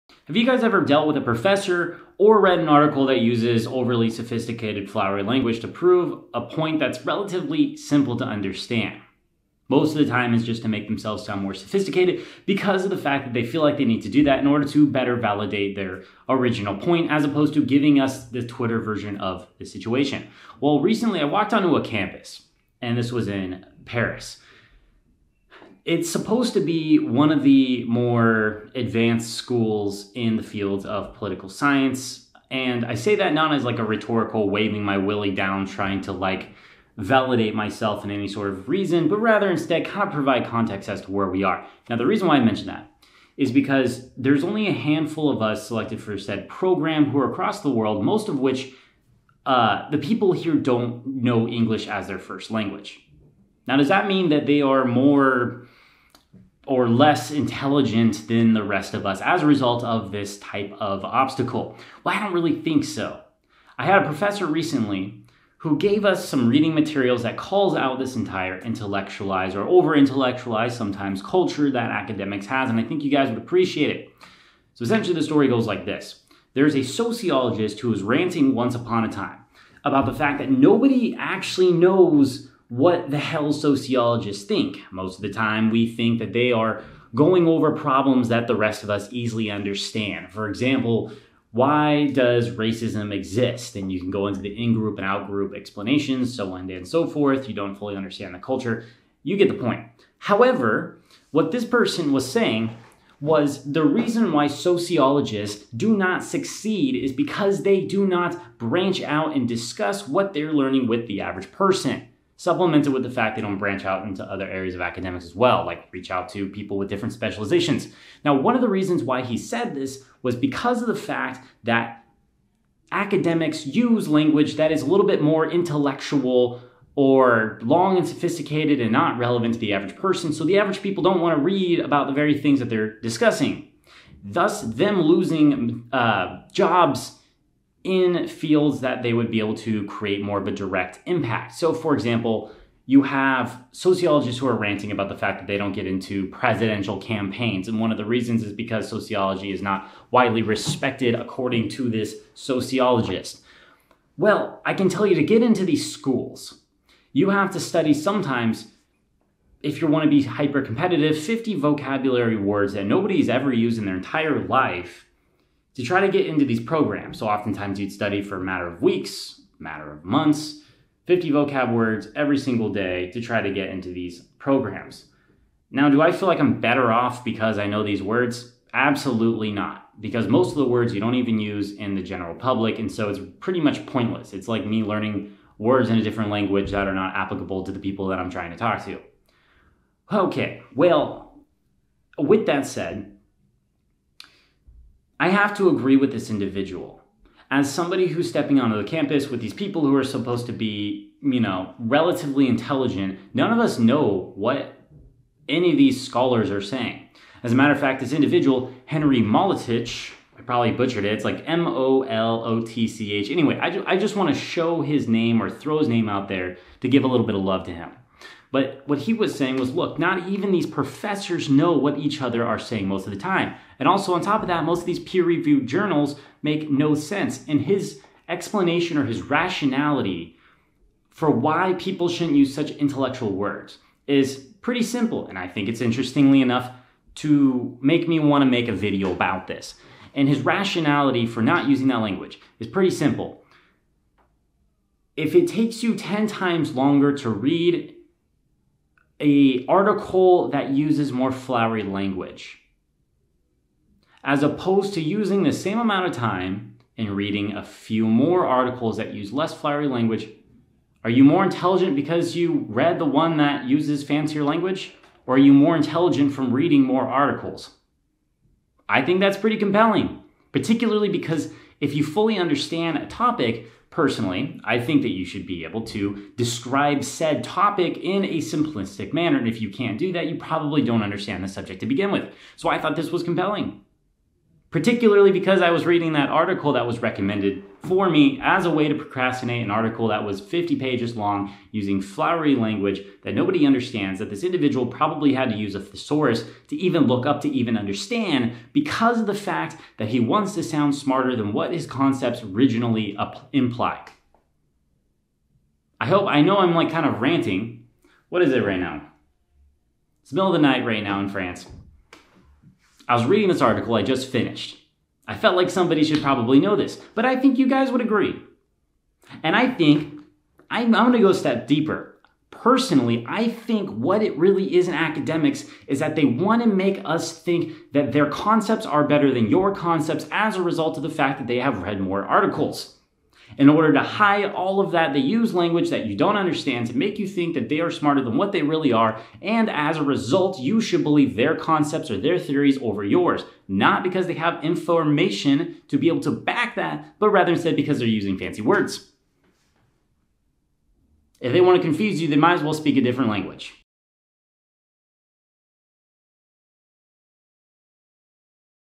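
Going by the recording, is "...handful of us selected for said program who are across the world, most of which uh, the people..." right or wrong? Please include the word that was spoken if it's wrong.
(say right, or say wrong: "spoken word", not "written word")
right.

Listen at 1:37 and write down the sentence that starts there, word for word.
You don't fully understand the culture.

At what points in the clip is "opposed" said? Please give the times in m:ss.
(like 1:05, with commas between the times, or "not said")
0:17, 4:14.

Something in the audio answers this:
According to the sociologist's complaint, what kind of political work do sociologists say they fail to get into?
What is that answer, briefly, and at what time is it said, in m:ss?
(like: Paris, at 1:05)
presidential campaigns, at 2:26.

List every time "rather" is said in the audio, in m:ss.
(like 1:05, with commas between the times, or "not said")
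0:39, 5:47.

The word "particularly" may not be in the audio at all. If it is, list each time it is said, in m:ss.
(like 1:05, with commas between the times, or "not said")
4:30, 4:44.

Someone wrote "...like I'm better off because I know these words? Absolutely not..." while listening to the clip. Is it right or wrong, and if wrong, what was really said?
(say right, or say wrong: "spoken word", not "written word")
right.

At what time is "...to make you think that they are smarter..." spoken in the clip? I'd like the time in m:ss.
5:36.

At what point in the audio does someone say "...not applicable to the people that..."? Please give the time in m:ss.
3:06.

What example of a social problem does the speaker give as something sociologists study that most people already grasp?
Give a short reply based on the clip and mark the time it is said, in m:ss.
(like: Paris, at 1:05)
racism, at 1:32.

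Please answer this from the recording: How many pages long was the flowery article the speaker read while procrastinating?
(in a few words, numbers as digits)
50 pages.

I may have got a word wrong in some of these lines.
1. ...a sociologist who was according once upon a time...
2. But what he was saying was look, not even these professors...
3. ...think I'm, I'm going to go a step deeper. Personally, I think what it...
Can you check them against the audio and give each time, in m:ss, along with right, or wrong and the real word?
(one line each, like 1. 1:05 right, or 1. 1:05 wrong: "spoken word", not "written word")
1. 1:16 wrong: "ranting", not "according"
2. 3:38 right
3. 5:19 right.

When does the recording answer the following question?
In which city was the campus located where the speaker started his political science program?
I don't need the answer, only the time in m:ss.
0:23.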